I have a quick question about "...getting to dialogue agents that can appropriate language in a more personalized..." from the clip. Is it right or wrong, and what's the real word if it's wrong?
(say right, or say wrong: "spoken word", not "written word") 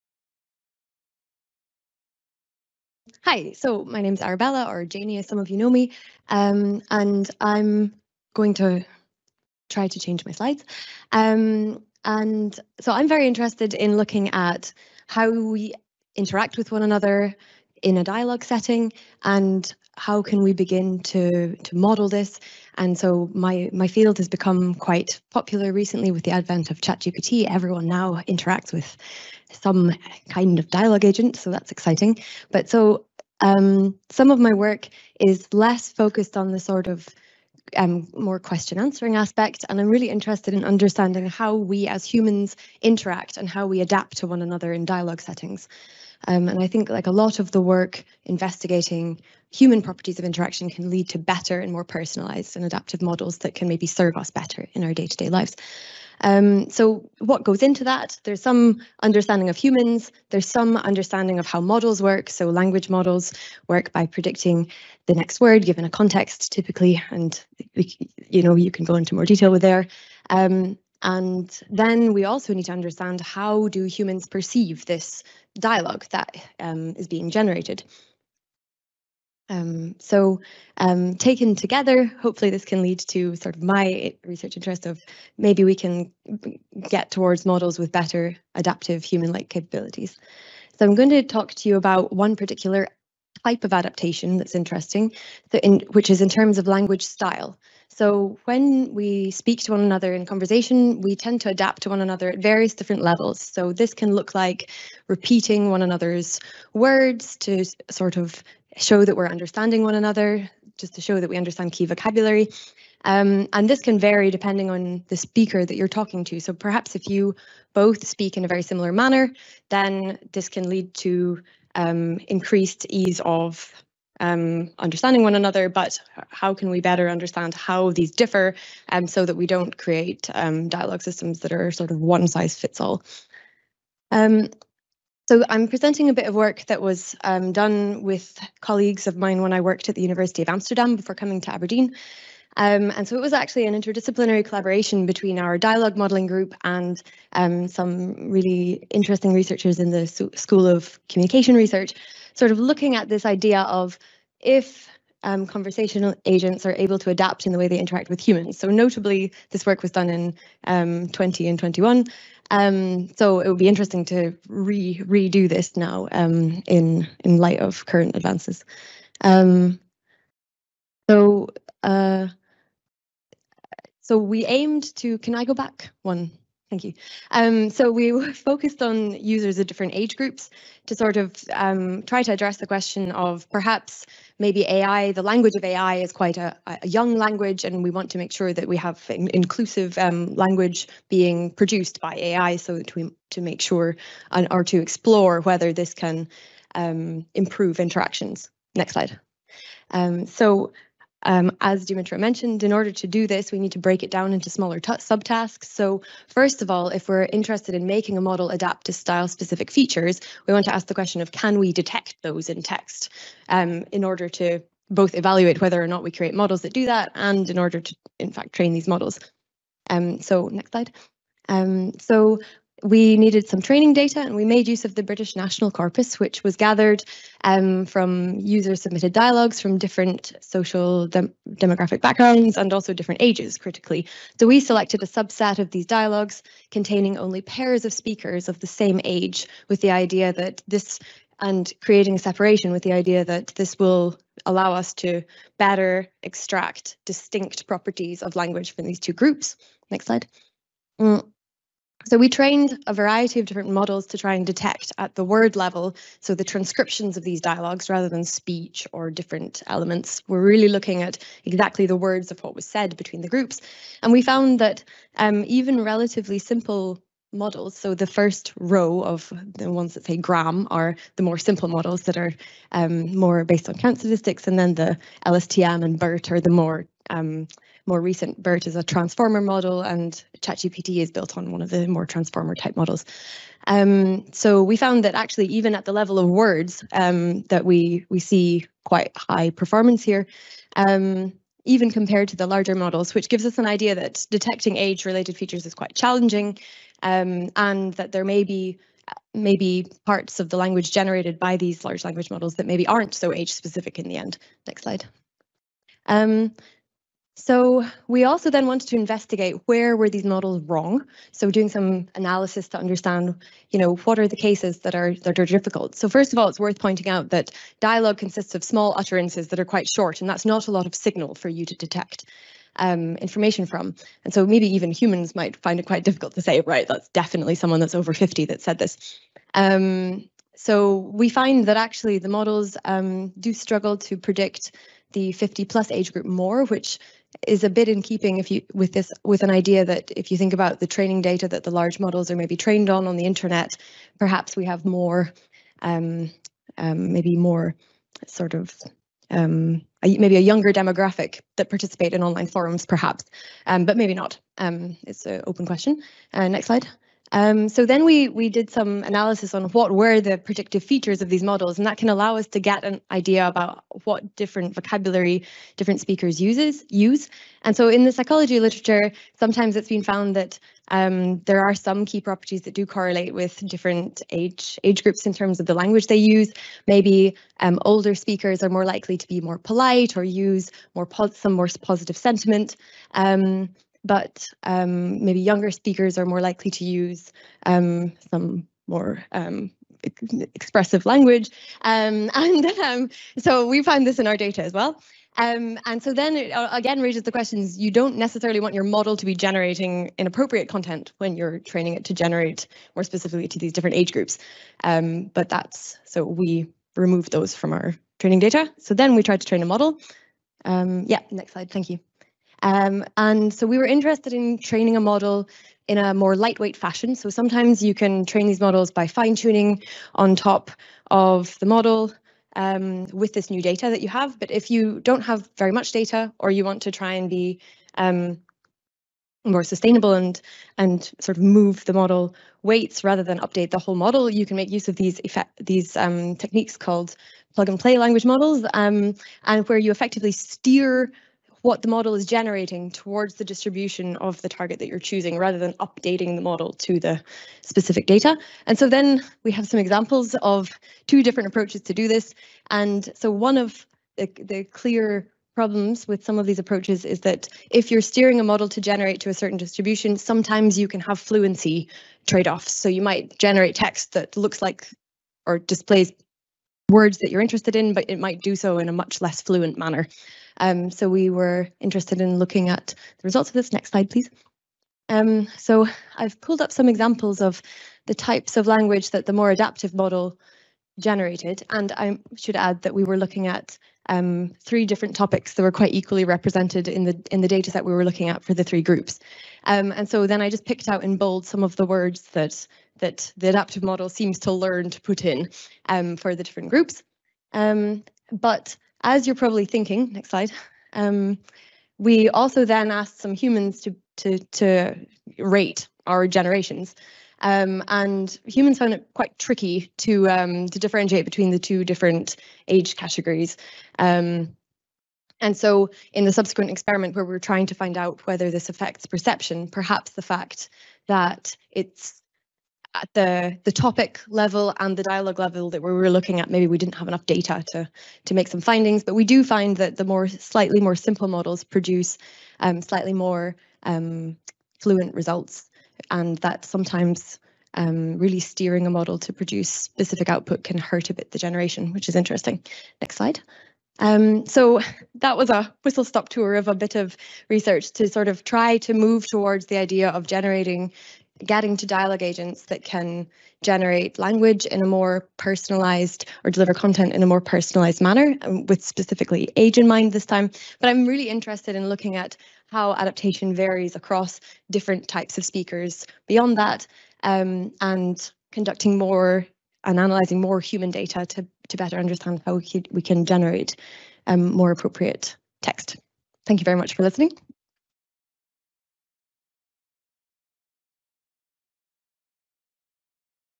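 wrong: "generate", not "appropriate".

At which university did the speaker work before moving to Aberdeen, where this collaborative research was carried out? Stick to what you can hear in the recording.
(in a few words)
University of Amsterdam.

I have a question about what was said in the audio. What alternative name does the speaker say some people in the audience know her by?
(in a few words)
Janie.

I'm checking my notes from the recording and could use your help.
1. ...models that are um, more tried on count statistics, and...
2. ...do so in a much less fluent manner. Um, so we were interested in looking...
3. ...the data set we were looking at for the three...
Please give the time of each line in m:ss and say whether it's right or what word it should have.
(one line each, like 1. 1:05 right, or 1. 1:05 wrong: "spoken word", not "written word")
1. 4:31 wrong: "based", not "tried"
2. 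7:48 right
3. 8:07 right.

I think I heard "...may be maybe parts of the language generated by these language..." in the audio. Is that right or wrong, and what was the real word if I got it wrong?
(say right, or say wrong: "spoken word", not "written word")
wrong: "large", not "language".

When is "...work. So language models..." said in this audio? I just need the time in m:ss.
1:02.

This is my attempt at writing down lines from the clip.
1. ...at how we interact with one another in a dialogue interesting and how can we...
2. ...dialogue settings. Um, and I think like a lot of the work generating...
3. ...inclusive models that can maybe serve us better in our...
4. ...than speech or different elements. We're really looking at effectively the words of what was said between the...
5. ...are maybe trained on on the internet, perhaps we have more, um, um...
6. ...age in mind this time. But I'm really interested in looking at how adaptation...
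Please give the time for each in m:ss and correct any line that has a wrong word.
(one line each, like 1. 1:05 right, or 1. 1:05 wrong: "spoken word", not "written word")
1. 0:14 wrong: "setting", not "interesting"
2. 0:44 wrong: "investigating", not "generating"
3. 0:52 wrong: "adaptive", not "inclusive"
4. 4:18 wrong: "exactly", not "effectively"
5. 5:42 right
6. 9:19 right.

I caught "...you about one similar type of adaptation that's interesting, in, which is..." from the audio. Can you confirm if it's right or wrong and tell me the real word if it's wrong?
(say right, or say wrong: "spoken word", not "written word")
wrong: "particular", not "similar".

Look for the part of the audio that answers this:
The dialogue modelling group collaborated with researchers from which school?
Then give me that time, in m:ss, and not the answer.
2:30.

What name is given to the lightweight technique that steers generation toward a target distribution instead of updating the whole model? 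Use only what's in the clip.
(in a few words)
plug and play language models.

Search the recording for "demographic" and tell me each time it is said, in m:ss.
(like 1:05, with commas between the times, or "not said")
3:51, 5:50.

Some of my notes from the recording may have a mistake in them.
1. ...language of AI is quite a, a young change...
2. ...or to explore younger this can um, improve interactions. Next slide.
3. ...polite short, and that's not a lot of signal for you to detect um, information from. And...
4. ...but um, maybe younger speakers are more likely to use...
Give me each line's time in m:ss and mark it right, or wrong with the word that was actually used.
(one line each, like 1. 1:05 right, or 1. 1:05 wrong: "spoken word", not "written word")
1. 3:05 wrong: "language", not "change"
2. 3:14 wrong: "whether", not "younger"
3. 5:19 wrong: "quite", not "polite"
4. 6:24 right.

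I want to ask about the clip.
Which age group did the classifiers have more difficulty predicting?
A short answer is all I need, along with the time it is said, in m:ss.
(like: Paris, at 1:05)
50 plus, at 5:35.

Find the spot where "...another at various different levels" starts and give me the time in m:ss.
1:42.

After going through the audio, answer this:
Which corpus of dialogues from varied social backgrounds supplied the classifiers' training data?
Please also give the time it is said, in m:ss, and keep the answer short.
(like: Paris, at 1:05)
British National Corpus, at 3:45.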